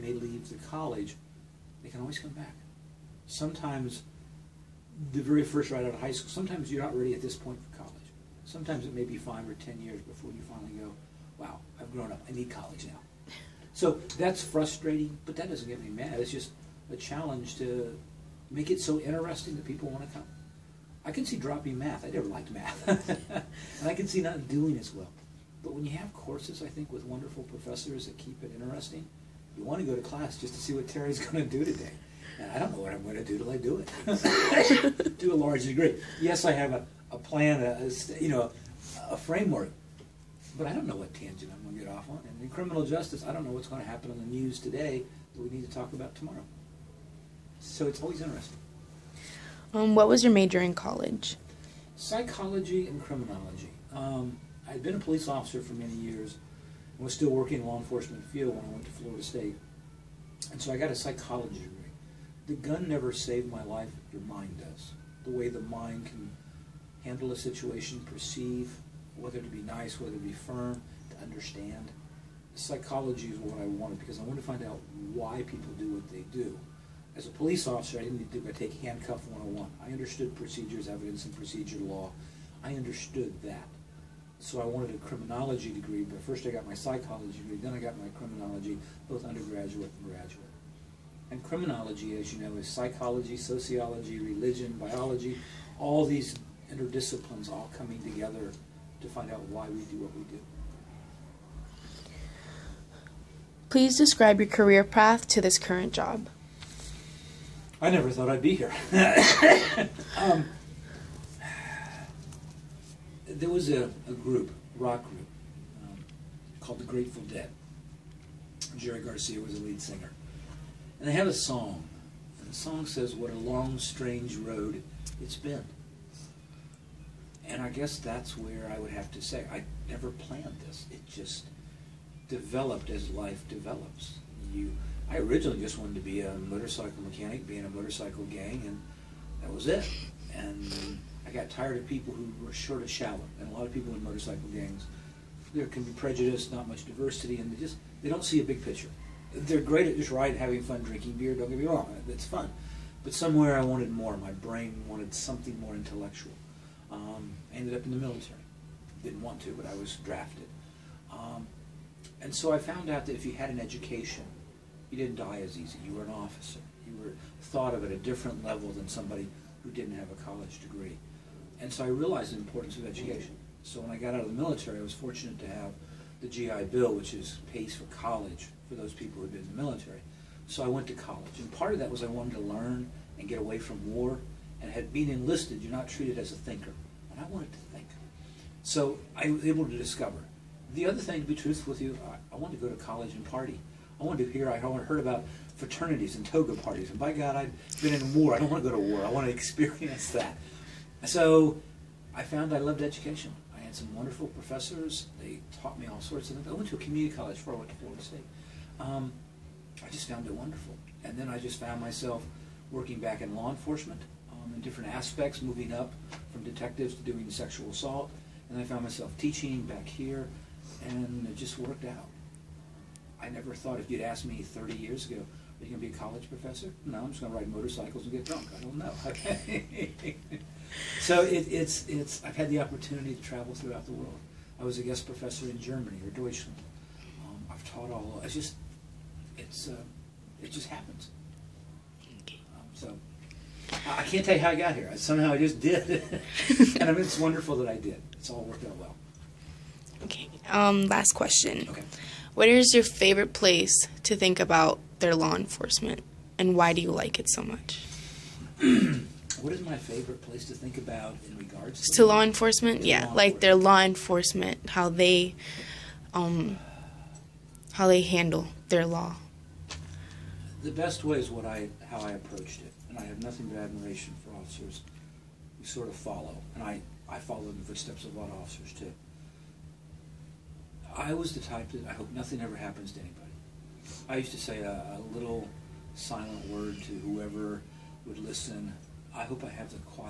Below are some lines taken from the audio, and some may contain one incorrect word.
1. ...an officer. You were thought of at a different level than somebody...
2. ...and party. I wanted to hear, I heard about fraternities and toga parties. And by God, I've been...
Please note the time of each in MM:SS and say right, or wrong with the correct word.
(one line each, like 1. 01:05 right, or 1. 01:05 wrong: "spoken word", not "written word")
1. 02:46 right
2. 03:13 right.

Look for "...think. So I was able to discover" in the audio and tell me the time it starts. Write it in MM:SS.
03:07.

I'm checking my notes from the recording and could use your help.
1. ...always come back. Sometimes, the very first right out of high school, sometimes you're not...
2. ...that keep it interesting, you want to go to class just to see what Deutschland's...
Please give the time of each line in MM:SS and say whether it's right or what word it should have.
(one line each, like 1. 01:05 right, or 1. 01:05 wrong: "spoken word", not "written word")
1. 00:02 right
2. 00:28 wrong: "Terry", not "Deutschland".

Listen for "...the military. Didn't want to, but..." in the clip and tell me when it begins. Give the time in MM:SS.
02:37.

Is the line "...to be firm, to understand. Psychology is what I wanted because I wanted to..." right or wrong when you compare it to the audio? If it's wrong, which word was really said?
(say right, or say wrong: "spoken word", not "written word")
right.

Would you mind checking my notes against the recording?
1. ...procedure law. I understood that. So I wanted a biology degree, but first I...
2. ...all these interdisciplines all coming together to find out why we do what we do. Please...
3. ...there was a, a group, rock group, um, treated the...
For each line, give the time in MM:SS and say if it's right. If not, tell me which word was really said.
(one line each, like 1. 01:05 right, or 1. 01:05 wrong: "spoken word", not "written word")
1. 01:21 wrong: "criminology", not "biology"
2. 01:35 right
3. 01:53 wrong: "called", not "treated".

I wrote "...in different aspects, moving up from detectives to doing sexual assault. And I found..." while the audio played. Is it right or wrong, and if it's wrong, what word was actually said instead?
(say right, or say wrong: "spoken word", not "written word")
right.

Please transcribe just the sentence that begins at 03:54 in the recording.
I was a guest professor in Germany or Deutschland.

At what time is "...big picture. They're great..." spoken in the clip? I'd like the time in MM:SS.
02:28.